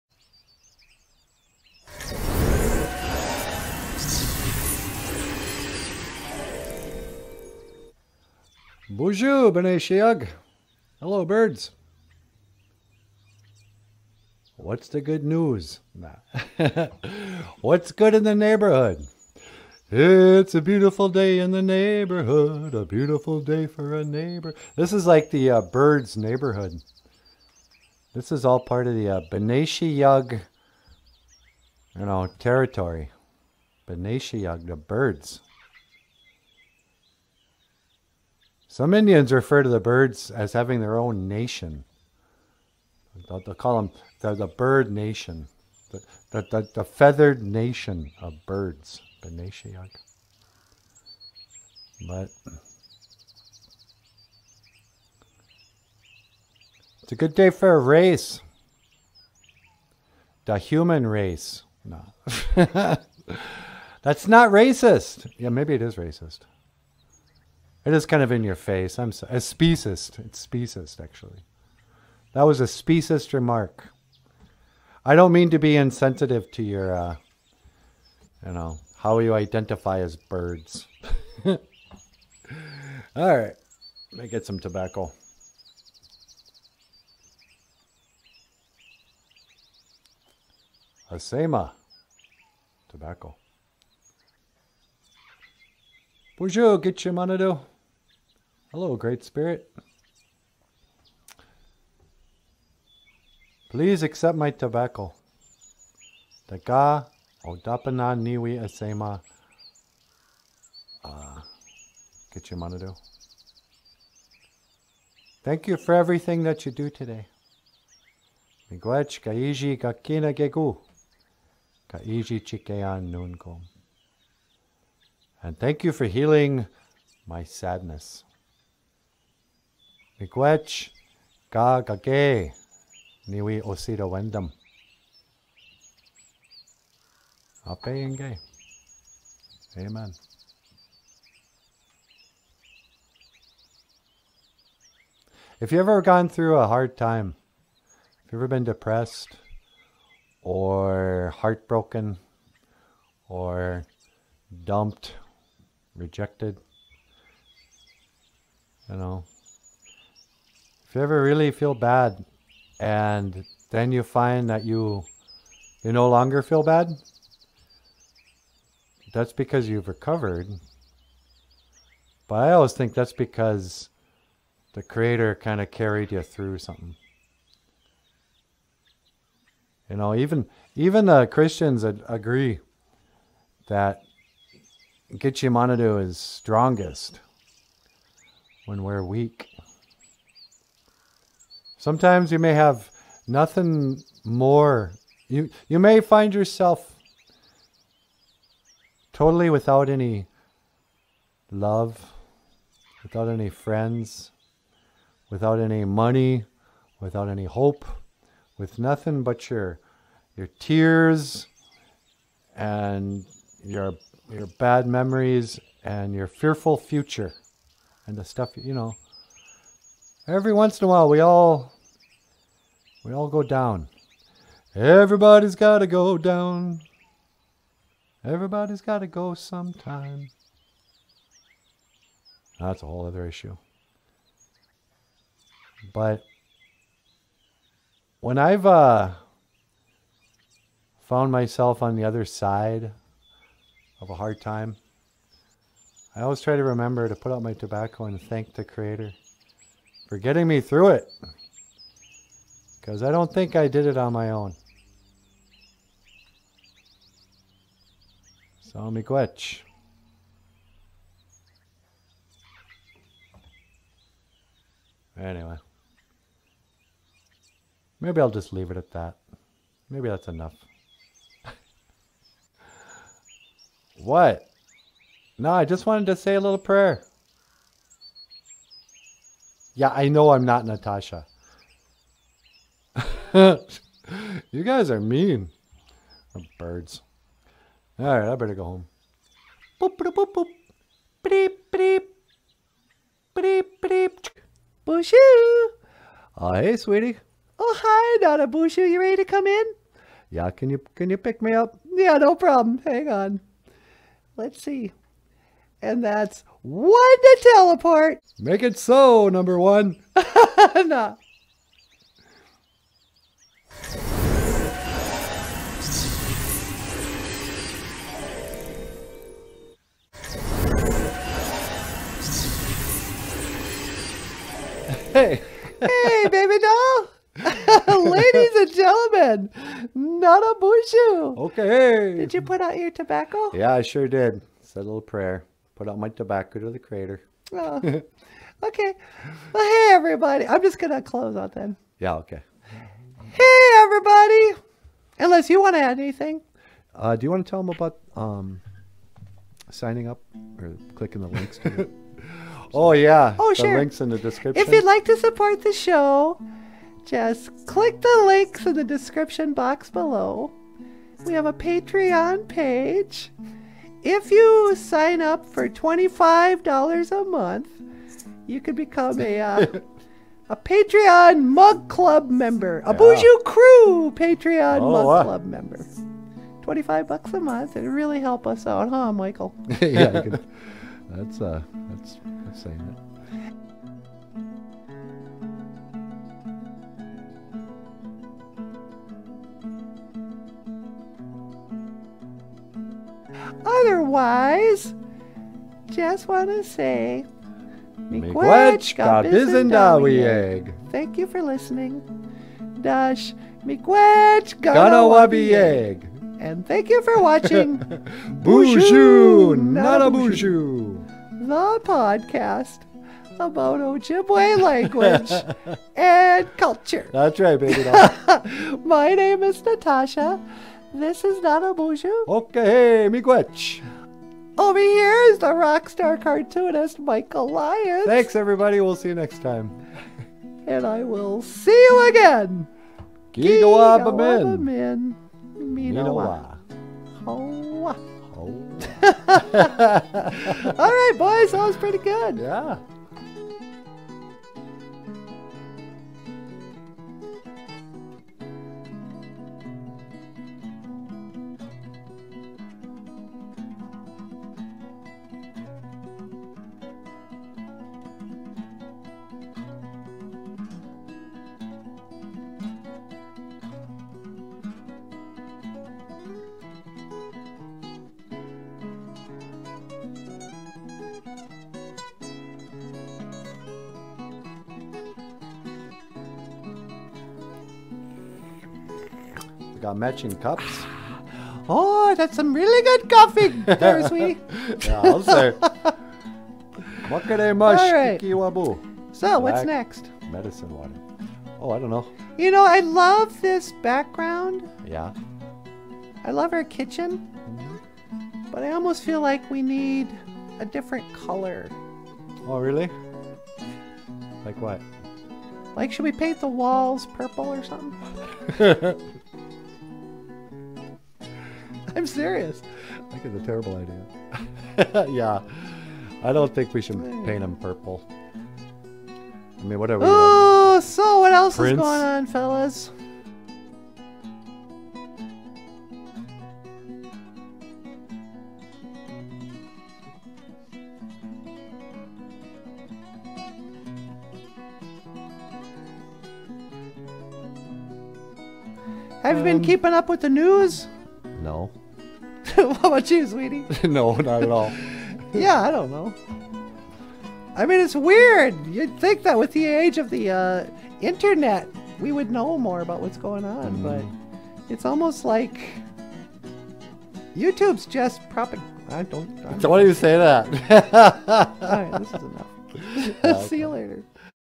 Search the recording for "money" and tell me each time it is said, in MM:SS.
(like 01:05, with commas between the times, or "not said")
01:37, 03:25.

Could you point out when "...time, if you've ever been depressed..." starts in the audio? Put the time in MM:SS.
02:26.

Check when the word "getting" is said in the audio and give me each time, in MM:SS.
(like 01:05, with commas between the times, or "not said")
04:10.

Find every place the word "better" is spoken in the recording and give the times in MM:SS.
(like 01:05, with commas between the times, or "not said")
04:48.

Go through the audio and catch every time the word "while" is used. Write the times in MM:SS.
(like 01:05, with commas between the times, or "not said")
03:40.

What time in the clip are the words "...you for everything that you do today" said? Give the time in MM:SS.
01:55.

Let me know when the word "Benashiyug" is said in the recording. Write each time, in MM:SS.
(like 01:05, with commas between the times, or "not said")
00:29, 00:33.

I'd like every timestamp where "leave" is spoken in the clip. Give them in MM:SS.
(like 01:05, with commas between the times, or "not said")
04:28.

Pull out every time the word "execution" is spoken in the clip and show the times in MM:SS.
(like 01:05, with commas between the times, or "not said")
not said.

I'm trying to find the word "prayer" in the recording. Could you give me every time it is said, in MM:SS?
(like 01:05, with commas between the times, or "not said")
04:36, 05:35.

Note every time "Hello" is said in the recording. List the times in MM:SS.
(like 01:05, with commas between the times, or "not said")
00:10, 01:38.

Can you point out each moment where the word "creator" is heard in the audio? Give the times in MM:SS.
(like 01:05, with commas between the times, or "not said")
02:54, 04:08.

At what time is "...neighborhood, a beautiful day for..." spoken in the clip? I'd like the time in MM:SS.
00:21.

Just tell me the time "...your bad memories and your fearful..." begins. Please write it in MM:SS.
03:34.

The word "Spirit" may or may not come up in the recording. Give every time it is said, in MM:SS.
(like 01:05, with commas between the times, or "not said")
01:39.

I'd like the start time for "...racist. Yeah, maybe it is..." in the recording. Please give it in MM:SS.
01:04.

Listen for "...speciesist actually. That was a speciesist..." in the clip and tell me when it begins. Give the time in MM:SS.
01:10.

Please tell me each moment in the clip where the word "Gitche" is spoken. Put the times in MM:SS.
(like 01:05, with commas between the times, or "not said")
03:05.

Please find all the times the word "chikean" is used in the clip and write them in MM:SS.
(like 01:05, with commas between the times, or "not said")
02:02.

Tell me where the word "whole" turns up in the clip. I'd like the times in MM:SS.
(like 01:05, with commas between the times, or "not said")
03:52.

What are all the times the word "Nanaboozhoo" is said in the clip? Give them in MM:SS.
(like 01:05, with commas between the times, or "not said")
05:29, 07:01.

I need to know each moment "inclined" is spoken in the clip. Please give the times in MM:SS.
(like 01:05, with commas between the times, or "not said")
not said.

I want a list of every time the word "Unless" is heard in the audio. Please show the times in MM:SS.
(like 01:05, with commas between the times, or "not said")
05:45.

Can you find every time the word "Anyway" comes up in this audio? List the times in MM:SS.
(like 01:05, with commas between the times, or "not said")
04:25.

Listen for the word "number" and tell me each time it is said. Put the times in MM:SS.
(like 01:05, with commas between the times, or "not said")
05:09.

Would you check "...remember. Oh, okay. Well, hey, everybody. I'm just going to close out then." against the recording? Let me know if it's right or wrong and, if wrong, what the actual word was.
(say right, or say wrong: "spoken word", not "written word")
wrong: "crater", not "remember".